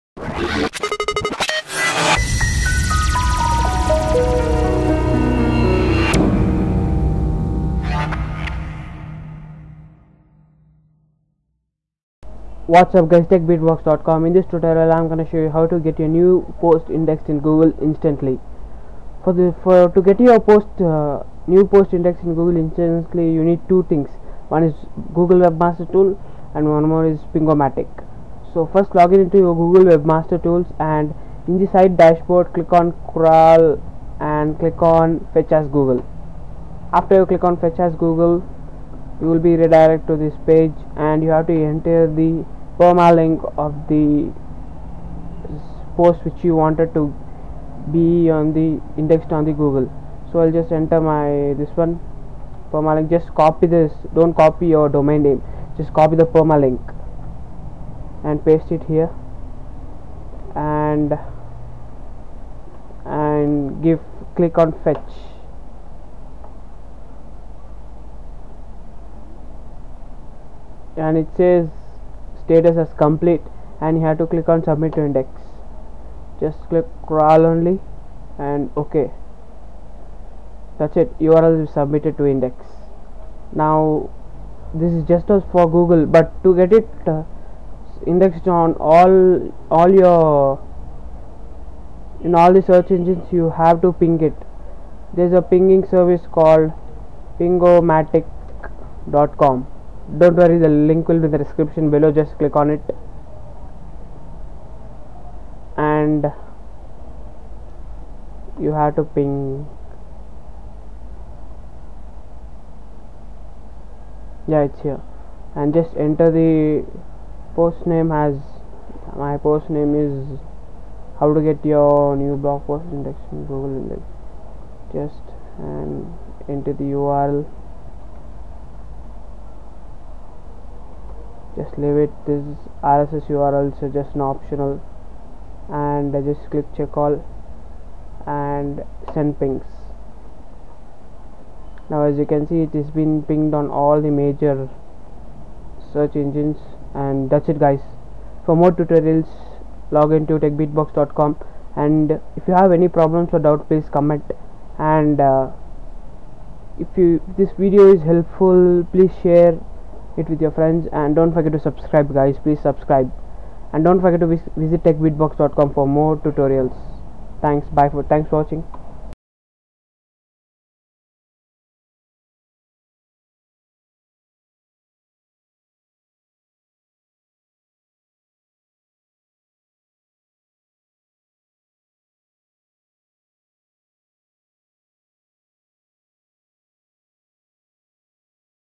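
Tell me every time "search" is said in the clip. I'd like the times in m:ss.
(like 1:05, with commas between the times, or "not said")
1:32, 2:25.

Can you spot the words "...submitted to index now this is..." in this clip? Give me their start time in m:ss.
1:21.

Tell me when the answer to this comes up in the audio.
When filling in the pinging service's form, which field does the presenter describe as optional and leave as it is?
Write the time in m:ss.
2:12.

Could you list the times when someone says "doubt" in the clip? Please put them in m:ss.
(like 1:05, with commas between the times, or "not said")
2:33.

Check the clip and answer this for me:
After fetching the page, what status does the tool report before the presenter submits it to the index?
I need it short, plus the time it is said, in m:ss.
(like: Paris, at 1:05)
complete, at 1:12.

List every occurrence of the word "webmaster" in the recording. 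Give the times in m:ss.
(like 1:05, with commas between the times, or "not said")
0:25, 0:29.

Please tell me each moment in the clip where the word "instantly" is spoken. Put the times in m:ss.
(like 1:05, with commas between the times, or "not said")
0:17, 0:22.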